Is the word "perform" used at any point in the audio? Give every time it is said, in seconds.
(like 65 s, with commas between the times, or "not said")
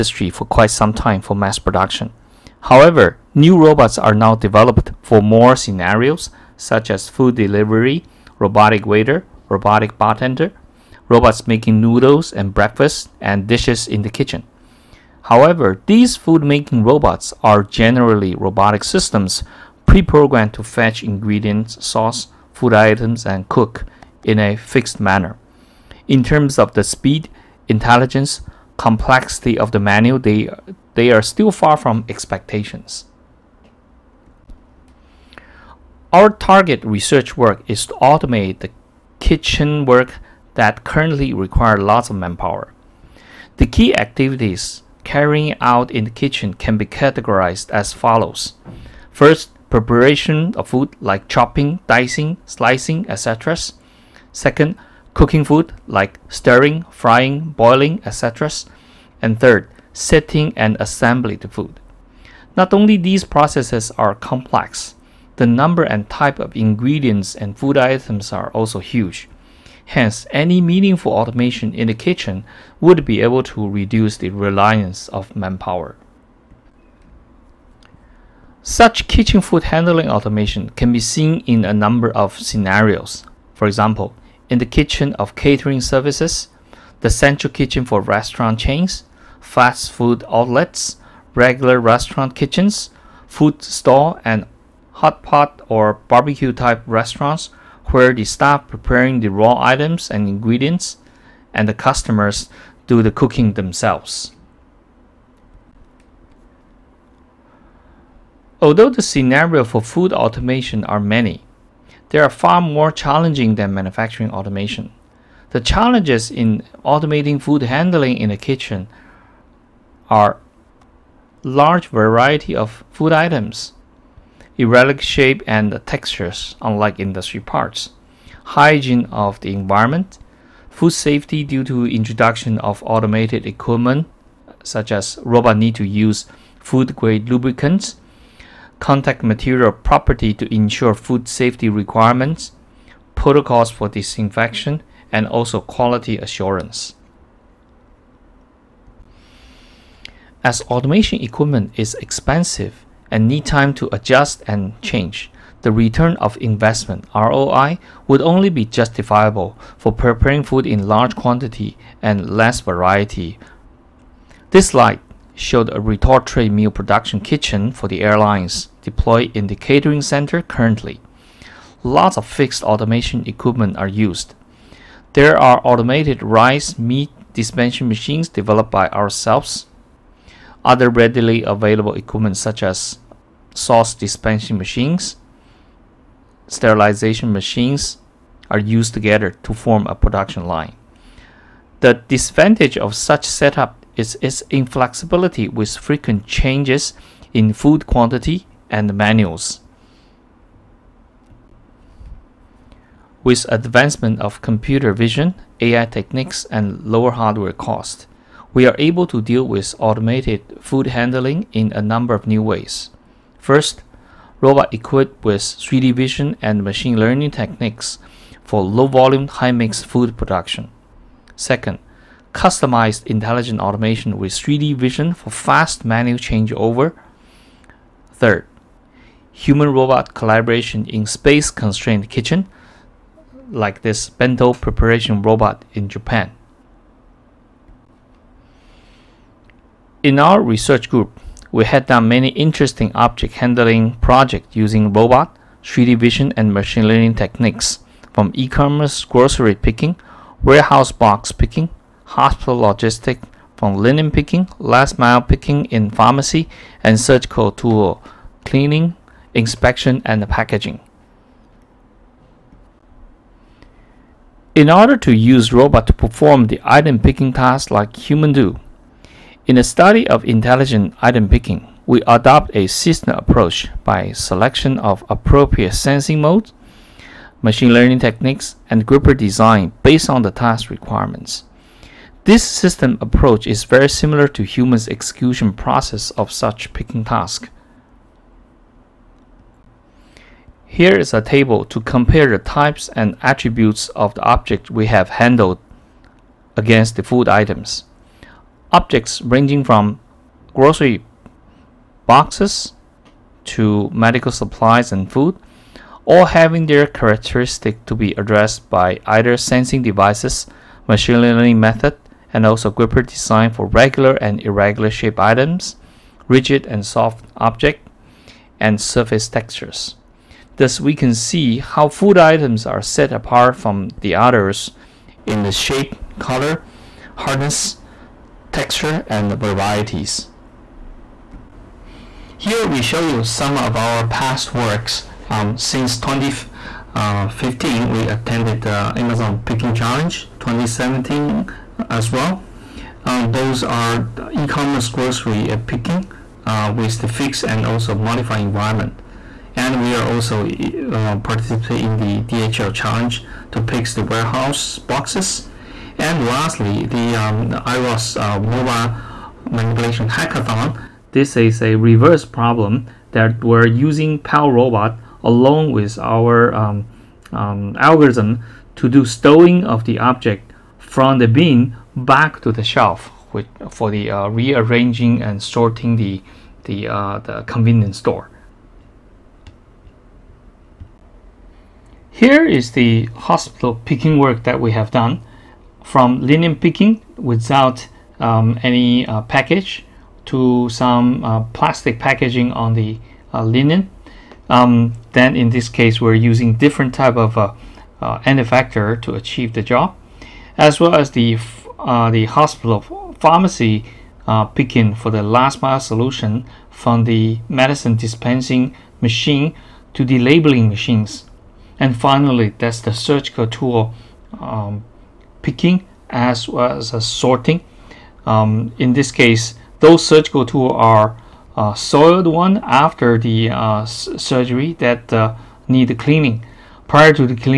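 265 s.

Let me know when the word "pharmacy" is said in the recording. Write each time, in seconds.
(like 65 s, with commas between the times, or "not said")
255 s, 403 s.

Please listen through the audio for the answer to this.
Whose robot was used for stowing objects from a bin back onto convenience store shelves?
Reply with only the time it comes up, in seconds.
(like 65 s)
364 s.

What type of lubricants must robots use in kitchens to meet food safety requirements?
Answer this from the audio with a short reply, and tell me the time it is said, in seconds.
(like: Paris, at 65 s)
Food-grade lubricants, at 136 s.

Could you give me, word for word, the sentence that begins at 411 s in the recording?
And finally, that's the surgical tool um, picking as well as sorting.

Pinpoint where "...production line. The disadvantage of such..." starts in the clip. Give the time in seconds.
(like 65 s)
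189 s.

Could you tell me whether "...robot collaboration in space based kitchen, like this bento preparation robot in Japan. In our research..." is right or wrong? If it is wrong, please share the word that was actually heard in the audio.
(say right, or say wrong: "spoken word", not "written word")
wrong: "constrained", not "based".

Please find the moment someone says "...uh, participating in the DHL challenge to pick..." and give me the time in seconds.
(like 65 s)
350 s.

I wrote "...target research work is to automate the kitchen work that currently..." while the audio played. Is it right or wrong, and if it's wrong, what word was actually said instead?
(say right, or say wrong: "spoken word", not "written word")
right.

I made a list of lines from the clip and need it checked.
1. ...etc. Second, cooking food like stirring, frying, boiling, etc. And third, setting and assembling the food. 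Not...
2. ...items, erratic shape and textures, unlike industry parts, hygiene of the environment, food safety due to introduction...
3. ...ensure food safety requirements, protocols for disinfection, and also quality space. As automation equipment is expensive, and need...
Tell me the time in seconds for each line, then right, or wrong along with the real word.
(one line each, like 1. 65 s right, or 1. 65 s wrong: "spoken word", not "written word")
1. 53 s right
2. 123 s right
3. 140 s wrong: "assurance", not "space".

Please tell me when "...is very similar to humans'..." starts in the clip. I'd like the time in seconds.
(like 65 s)
283 s.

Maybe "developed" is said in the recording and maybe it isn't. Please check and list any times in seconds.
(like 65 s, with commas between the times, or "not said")
4 s, 178 s.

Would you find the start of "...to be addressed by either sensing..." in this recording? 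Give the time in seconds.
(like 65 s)
307 s.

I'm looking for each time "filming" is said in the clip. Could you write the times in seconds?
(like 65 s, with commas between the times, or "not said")
not said.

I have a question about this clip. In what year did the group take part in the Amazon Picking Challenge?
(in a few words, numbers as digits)
2017.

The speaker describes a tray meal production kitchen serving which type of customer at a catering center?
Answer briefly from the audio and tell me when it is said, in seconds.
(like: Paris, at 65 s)
Airlines, at 168 s.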